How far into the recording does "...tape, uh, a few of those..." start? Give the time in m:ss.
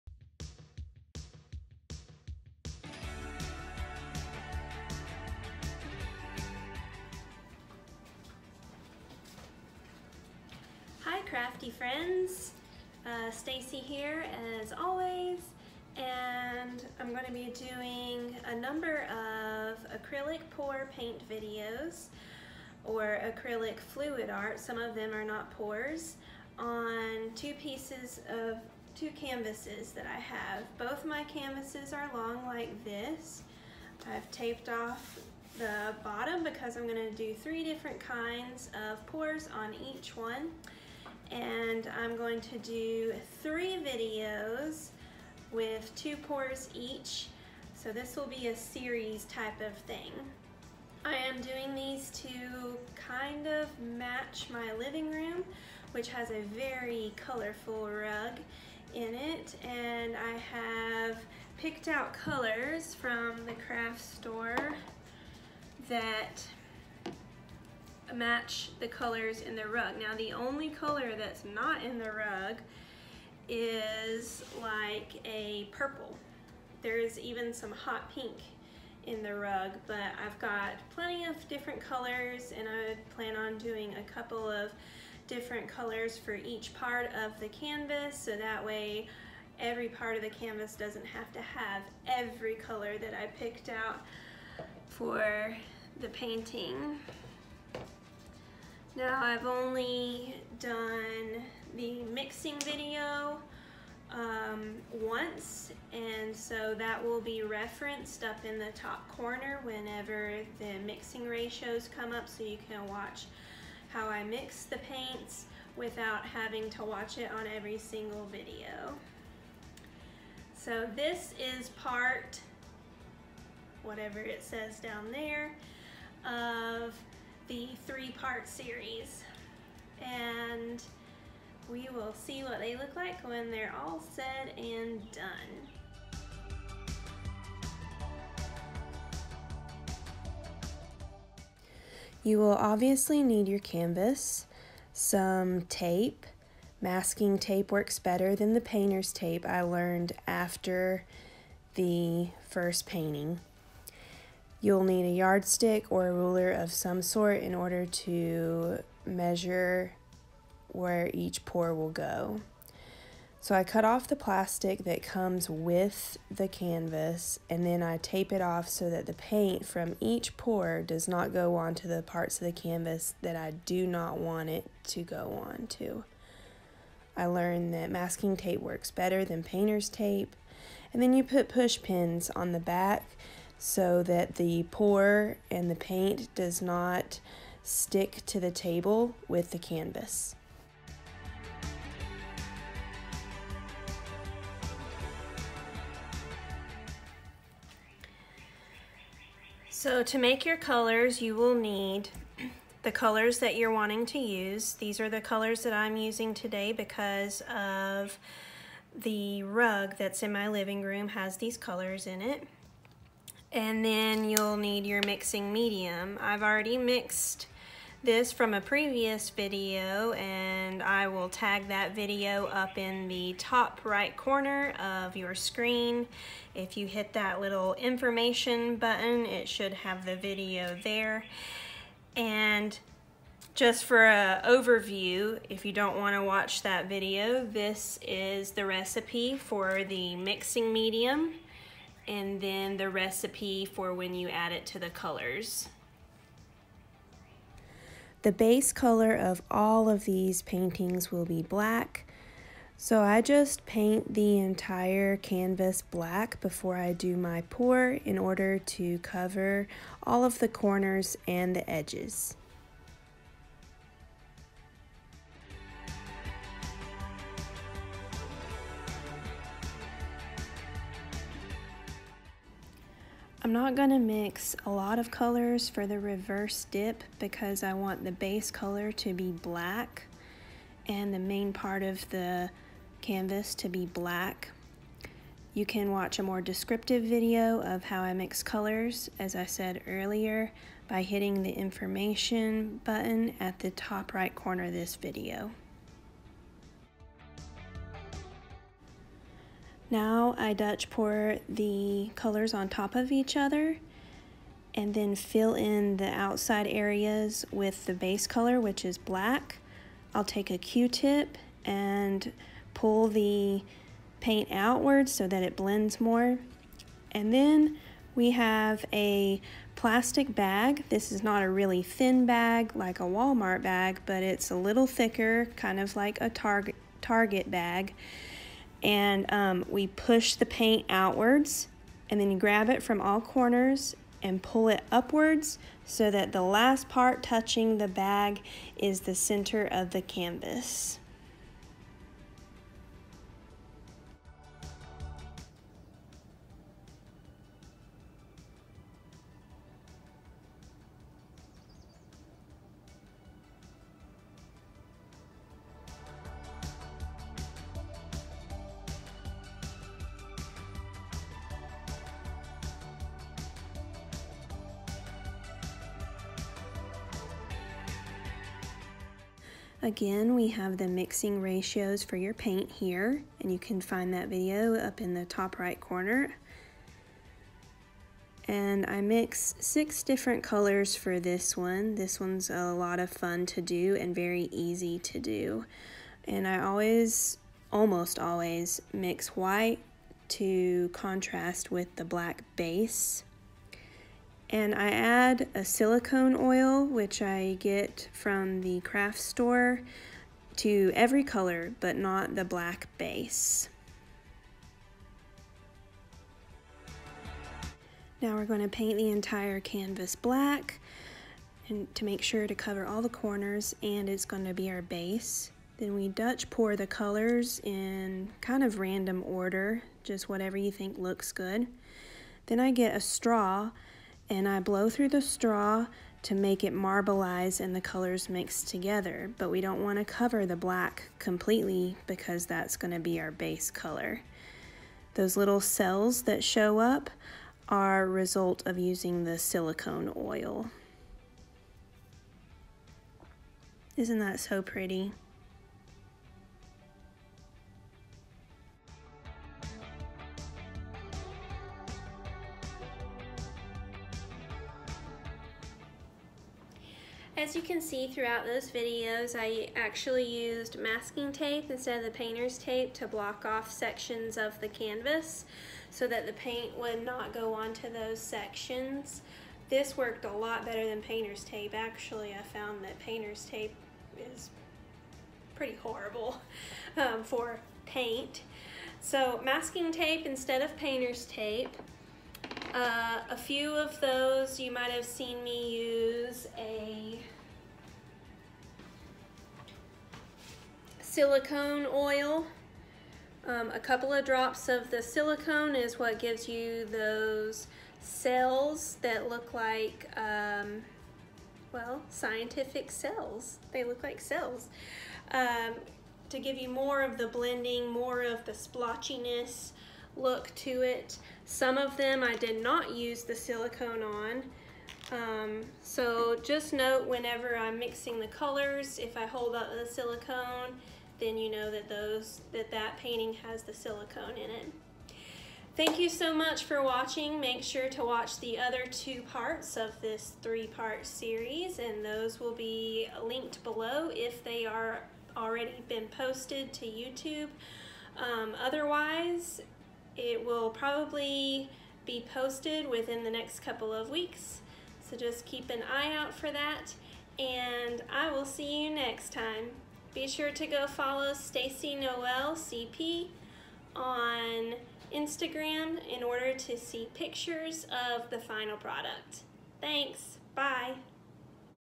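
8:01.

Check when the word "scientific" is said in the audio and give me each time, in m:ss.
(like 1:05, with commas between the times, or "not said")
8:22.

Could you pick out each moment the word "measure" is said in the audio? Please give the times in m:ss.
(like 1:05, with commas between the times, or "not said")
2:39.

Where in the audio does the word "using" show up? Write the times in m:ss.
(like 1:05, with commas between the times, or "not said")
3:25, 7:18.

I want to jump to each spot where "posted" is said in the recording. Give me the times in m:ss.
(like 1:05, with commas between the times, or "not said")
8:56, 9:02.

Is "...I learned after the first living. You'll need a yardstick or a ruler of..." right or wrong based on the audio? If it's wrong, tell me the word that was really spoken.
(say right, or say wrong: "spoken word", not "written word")
wrong: "painting", not "living".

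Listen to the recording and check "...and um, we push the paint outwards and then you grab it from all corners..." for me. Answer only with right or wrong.
right.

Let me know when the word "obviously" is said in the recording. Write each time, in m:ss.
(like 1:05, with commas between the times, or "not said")
2:22.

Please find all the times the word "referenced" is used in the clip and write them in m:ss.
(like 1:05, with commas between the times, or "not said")
1:47.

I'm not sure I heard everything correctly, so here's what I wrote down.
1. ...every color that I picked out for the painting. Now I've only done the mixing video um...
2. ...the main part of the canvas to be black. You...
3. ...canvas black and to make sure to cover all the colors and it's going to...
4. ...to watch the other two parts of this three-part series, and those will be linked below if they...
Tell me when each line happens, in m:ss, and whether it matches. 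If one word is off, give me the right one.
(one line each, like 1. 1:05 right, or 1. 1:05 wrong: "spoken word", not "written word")
1. 1:32 right
2. 4:41 right
3. 6:49 wrong: "corners", not "colors"
4. 8:47 right.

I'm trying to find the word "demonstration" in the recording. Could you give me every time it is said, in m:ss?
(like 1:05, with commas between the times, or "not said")
not said.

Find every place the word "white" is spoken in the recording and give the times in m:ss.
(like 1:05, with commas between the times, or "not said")
6:29.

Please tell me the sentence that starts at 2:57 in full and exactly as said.
I learned that masking tape works better than painter's tape.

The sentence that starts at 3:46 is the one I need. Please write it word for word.
If you hit that little information button, it should have the video there.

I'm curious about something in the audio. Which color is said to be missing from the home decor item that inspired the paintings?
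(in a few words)
Purple.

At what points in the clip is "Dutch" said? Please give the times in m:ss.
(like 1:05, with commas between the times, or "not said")
5:00, 6:56.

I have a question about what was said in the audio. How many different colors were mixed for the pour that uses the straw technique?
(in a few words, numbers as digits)
6.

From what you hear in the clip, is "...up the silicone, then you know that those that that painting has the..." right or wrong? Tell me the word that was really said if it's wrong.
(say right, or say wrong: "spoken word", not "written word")
right.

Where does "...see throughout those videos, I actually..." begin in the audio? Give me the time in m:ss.
7:37.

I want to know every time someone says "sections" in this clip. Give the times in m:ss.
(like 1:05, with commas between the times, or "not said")
7:43, 7:48.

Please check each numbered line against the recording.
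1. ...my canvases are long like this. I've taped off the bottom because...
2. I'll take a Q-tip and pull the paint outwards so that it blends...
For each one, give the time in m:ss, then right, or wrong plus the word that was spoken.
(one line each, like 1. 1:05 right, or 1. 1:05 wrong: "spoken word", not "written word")
1. 0:31 right
2. 5:10 right.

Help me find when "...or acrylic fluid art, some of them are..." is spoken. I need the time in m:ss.
0:22.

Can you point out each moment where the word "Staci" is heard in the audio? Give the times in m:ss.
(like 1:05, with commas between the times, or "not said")
0:13, 9:11.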